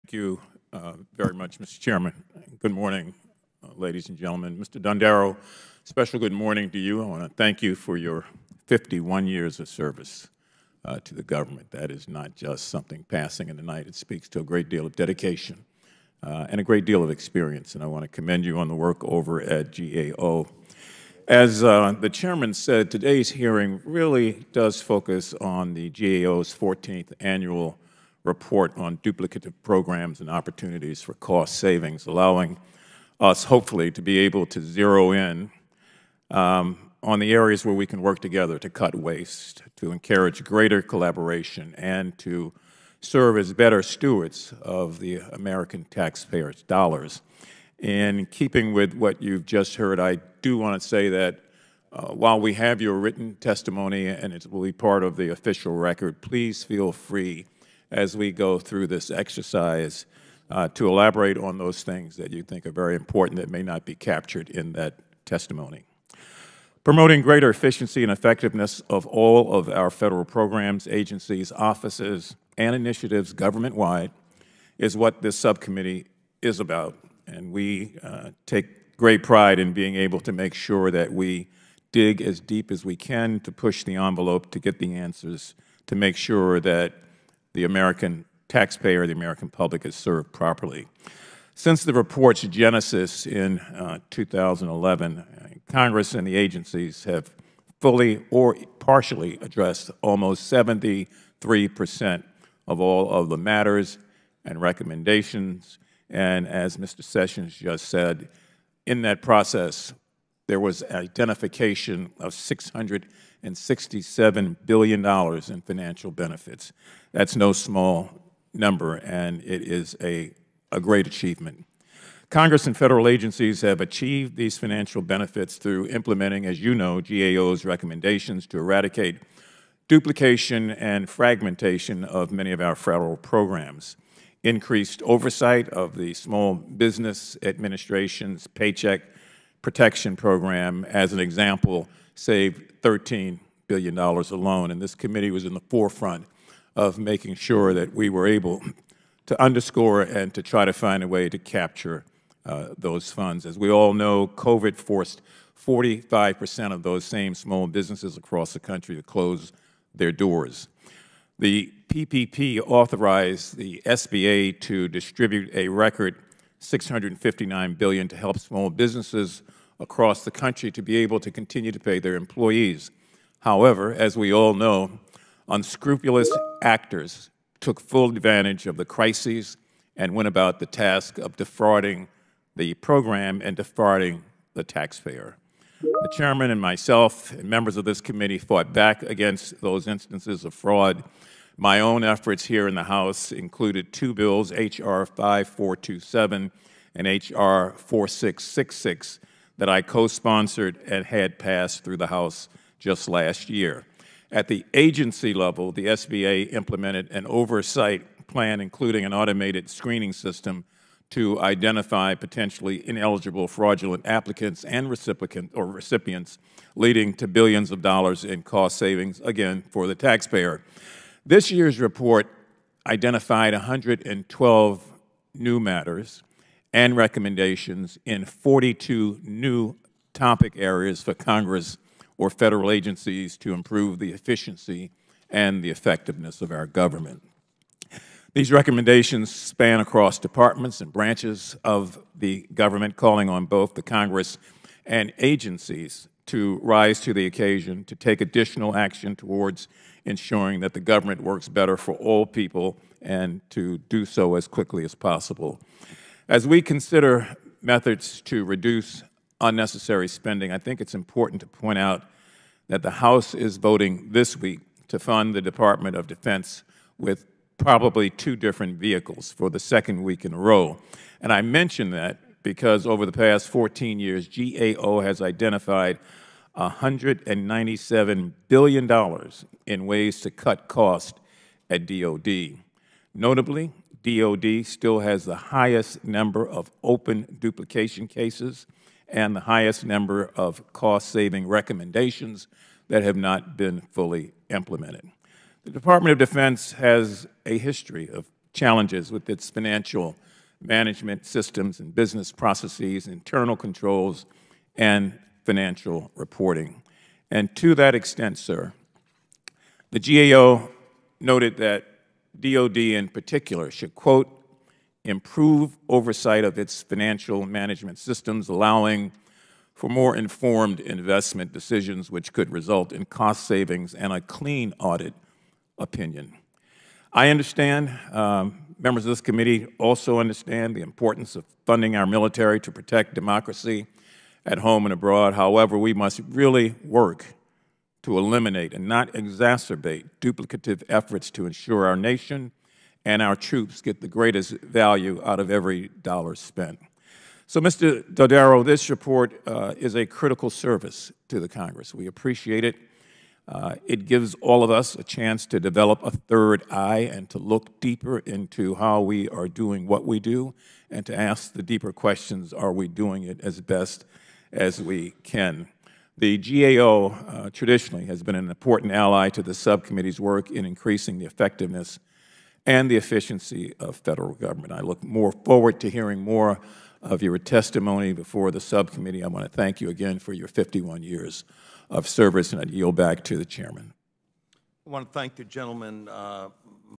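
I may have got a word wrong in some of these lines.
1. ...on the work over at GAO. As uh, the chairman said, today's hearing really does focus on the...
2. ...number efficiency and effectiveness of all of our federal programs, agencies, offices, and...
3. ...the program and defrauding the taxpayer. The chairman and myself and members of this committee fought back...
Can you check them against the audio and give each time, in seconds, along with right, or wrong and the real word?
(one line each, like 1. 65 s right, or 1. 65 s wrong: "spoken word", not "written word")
1. 18 s right
2. 67 s wrong: "greater", not "number"
3. 182 s right.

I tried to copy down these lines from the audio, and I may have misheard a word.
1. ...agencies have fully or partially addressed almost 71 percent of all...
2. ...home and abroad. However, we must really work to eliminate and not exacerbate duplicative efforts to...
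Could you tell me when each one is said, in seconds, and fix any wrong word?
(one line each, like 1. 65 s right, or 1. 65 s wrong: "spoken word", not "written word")
1. 96 s wrong: "73", not "71"
2. 334 s right.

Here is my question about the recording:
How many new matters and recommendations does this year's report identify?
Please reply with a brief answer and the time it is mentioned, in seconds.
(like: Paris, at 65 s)
112, at 223 s.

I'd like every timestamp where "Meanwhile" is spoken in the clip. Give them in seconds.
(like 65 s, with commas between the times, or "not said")
not said.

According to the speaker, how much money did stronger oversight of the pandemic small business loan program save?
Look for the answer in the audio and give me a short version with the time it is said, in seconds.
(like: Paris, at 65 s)
$13 billion, at 142 s.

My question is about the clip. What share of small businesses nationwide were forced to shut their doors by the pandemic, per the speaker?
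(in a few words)
45%.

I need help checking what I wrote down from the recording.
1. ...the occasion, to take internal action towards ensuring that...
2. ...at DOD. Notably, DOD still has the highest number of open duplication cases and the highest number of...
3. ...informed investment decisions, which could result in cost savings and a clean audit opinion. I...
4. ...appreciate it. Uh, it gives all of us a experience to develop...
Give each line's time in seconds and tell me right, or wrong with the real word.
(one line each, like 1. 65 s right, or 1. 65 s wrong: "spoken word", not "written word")
1. 247 s wrong: "additional", not "internal"
2. 281 s right
3. 320 s right
4. 352 s wrong: "chance", not "experience".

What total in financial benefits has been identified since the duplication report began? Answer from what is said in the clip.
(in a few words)
$667 billion.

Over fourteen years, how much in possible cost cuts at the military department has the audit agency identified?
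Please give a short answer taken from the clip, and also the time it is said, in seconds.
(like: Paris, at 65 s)
$197 billion, at 276 s.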